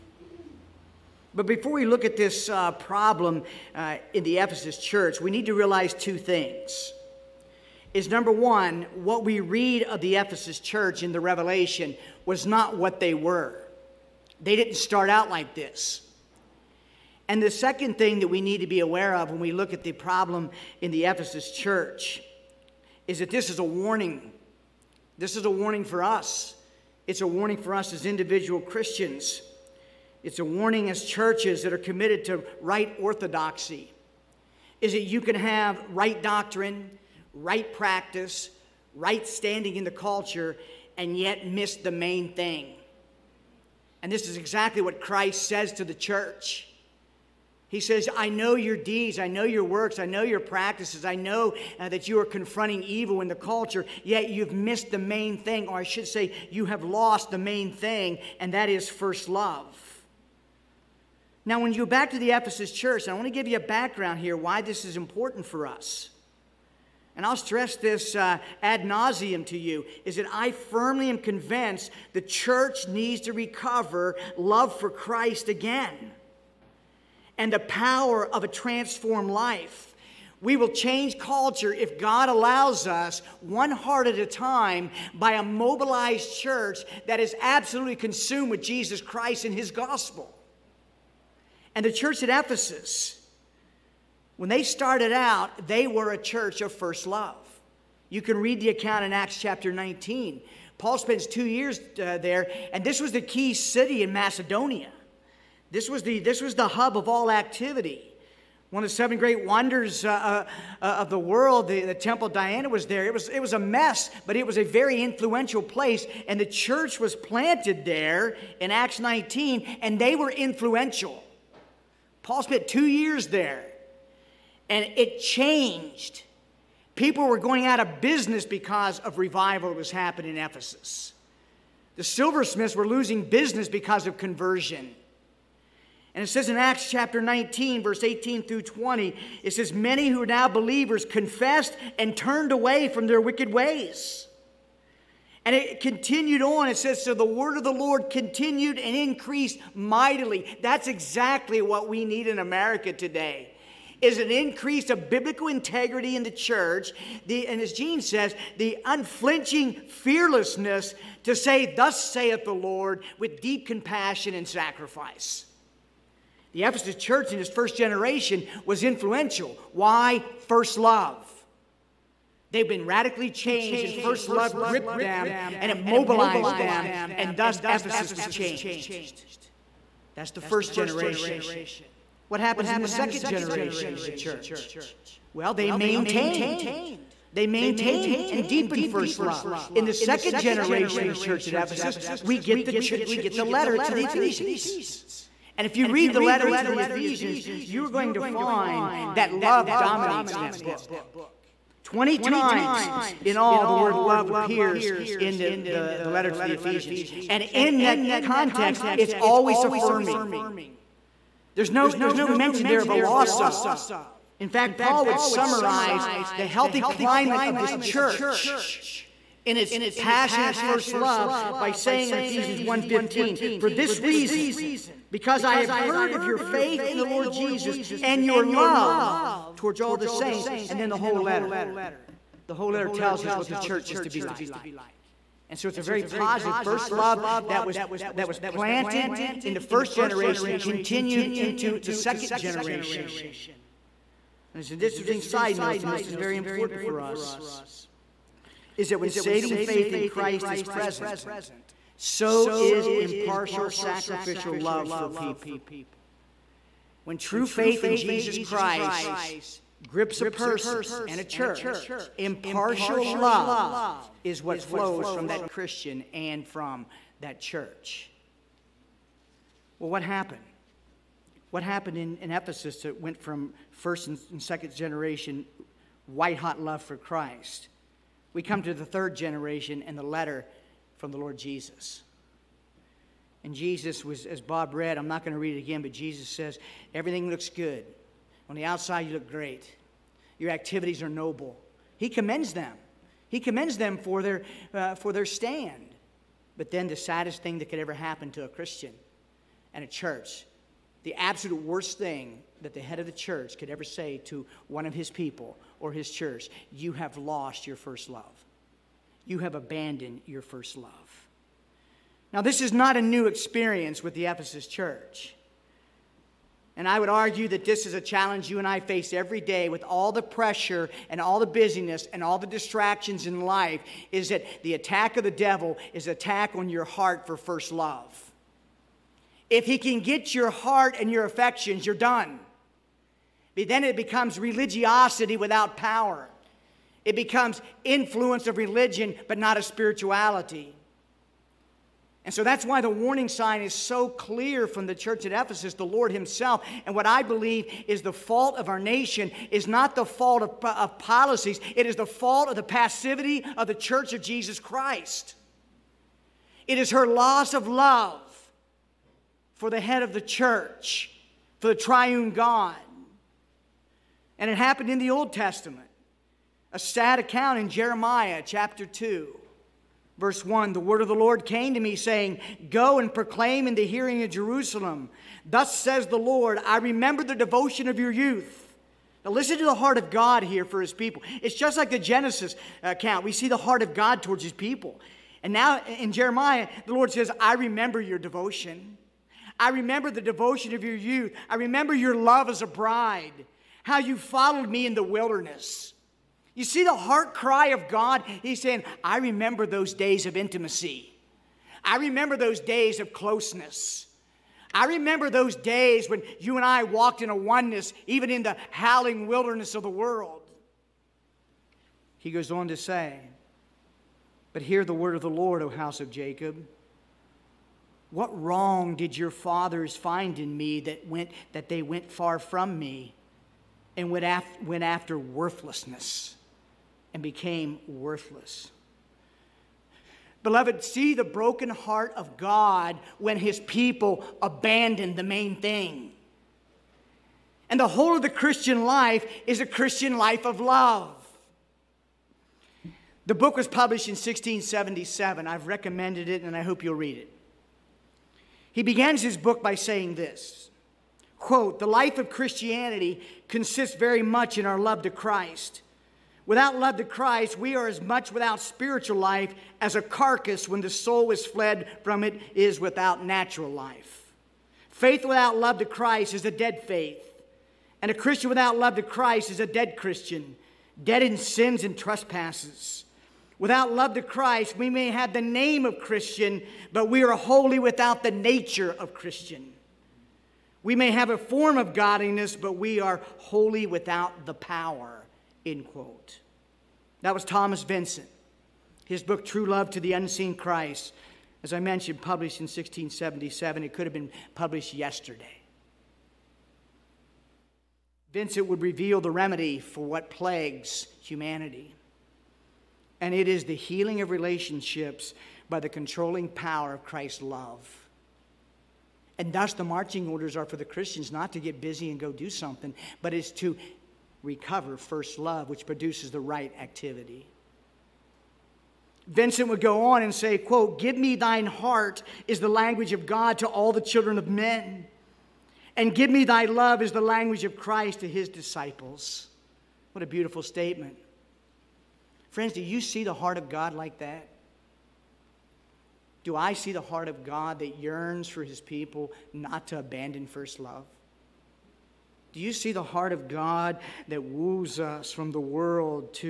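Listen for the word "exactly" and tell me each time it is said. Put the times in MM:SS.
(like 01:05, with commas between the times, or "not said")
00:44, 02:30.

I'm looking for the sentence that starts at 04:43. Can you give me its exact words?
And Jesus was, as Bob read, I'm not going to read it again, but Jesus says, Everything looks good.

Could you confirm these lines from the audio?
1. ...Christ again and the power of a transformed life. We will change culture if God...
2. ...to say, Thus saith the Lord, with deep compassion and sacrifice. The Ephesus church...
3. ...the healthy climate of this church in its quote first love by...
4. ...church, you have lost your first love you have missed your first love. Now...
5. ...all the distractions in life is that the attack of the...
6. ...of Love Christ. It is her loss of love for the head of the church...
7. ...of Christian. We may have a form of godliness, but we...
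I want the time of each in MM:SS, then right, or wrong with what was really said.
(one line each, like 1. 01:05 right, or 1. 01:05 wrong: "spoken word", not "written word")
1. 01:14 right
2. 02:41 right
3. 03:36 wrong: "passionate", not "quote"
4. 05:06 wrong: "abandoned", not "missed"
5. 05:22 right
6. 05:54 wrong: "Jesus", not "Love"
7. 07:58 right.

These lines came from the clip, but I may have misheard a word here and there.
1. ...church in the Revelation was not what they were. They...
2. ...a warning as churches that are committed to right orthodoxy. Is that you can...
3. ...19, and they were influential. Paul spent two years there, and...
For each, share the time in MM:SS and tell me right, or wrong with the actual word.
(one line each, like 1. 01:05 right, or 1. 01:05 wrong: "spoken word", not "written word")
1. 00:10 right
2. 00:30 right
3. 01:58 right.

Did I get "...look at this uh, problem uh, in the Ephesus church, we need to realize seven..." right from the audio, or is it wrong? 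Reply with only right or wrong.
wrong.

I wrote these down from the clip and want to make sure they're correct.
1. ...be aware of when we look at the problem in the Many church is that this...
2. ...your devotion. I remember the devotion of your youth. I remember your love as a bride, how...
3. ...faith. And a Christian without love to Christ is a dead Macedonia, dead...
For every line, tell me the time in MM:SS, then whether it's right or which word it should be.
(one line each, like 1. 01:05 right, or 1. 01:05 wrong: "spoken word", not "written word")
1. 00:18 wrong: "Ephesus", not "Many"
2. 06:27 right
3. 07:46 wrong: "Christian", not "Macedonia".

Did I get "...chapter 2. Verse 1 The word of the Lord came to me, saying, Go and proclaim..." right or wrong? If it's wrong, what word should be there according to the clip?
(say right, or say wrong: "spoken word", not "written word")
right.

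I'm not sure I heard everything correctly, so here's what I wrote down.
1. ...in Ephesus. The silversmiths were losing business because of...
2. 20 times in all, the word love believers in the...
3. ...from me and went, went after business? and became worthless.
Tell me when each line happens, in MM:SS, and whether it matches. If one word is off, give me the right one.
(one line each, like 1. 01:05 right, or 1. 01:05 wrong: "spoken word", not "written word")
1. 02:10 right
2. 03:21 wrong: "appears", not "believers"
3. 07:02 wrong: "worthlessness", not "business".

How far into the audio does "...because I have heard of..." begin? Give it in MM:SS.
03:45.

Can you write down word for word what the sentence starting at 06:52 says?
He goes on to say, But hear the word of the Lord, O house of Jacob.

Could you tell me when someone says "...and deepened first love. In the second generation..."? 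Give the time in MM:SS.
03:08.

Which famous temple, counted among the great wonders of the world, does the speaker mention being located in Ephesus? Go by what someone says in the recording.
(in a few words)
Temple Diana.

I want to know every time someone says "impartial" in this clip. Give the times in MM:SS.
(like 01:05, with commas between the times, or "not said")
04:12, 04:22.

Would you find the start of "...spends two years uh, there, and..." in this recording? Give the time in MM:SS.
01:40.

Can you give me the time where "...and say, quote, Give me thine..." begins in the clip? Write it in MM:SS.
08:40.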